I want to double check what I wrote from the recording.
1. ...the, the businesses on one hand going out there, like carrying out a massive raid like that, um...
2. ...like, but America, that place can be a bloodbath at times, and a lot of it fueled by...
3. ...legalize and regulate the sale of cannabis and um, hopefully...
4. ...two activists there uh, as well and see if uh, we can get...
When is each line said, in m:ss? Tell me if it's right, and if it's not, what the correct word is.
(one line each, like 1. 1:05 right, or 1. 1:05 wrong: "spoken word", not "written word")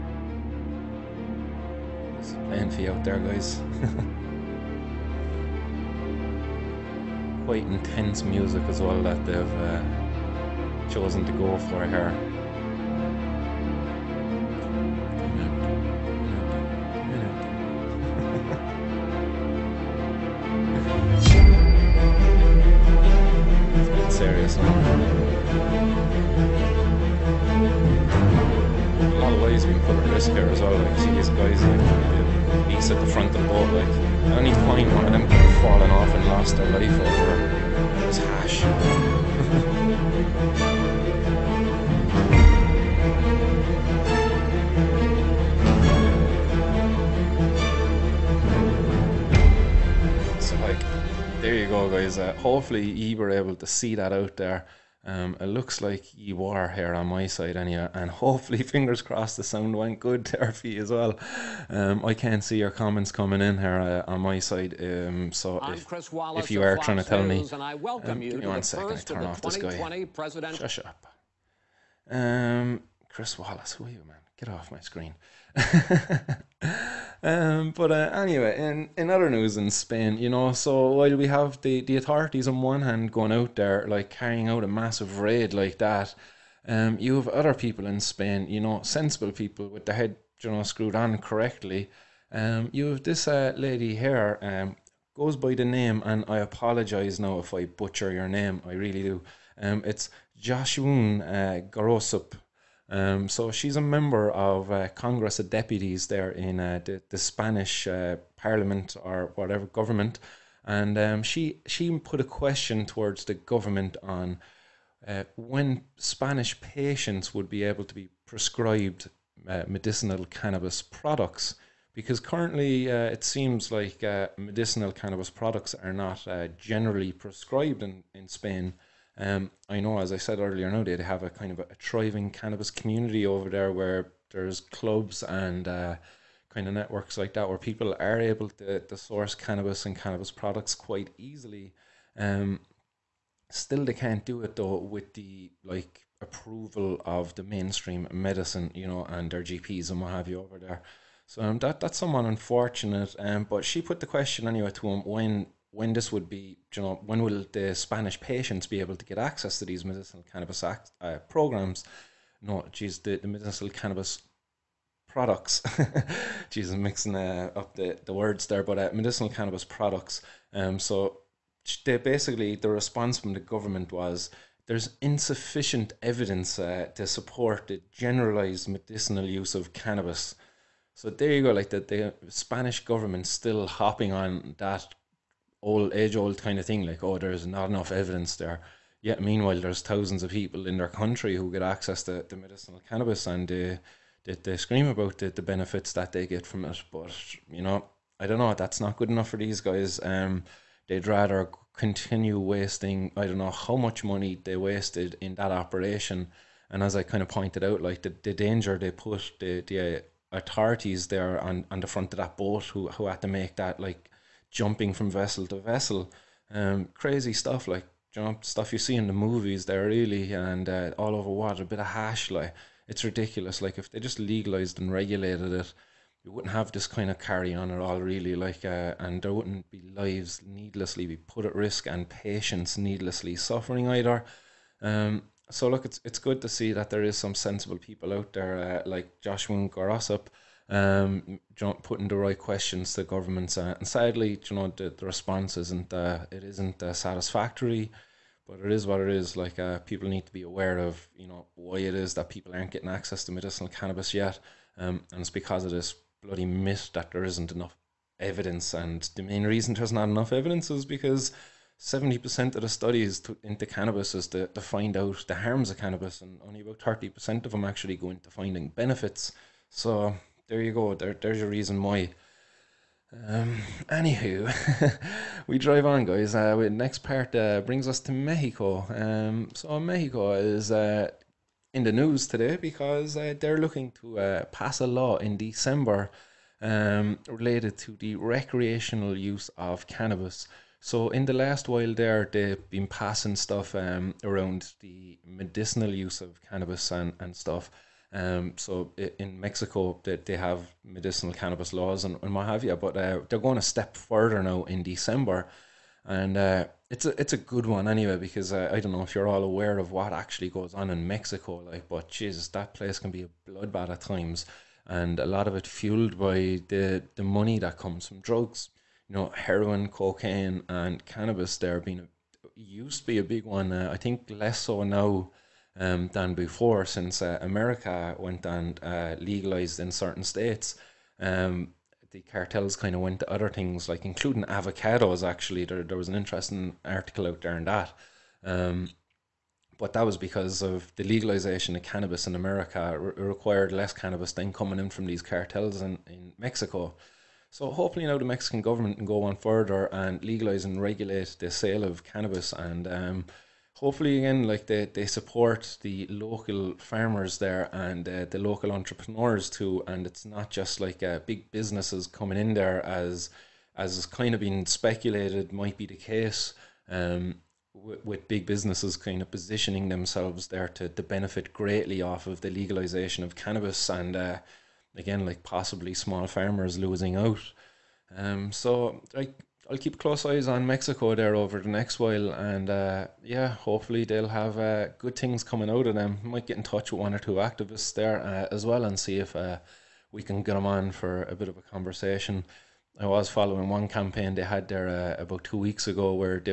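1. 1:21 wrong: "authorities", not "businesses"
2. 5:11 wrong: "Jesus", not "America"
3. 5:50 right
4. 6:27 right.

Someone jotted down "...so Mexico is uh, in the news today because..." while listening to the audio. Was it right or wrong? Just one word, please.
right.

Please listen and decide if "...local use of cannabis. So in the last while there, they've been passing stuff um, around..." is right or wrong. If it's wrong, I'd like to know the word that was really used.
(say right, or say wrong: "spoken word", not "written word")
wrong: "recreational", not "local".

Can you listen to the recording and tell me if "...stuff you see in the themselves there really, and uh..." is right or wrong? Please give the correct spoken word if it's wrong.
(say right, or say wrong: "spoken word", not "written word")
wrong: "movies", not "themselves".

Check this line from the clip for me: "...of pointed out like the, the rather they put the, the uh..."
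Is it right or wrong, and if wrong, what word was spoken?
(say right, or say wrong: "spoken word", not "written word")
wrong: "danger", not "rather".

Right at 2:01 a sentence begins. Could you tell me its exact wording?
Because currently, uh, it seems like medicinal cannabis products are not generally prescribed in, in Spain.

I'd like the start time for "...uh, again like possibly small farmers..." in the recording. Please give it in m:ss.
6:14.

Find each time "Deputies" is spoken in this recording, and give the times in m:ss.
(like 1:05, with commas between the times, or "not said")
1:45.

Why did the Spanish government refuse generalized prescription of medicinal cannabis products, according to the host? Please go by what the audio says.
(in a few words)
insufficient evidence.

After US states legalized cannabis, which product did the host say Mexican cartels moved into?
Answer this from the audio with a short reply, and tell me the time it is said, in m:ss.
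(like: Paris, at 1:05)
avocados, at 5:34.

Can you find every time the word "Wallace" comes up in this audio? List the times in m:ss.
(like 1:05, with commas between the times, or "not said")
1:06, 1:13.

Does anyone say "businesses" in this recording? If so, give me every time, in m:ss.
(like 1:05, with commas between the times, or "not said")
6:01, 6:08.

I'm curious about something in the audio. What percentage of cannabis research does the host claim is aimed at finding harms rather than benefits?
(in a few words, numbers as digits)
70%.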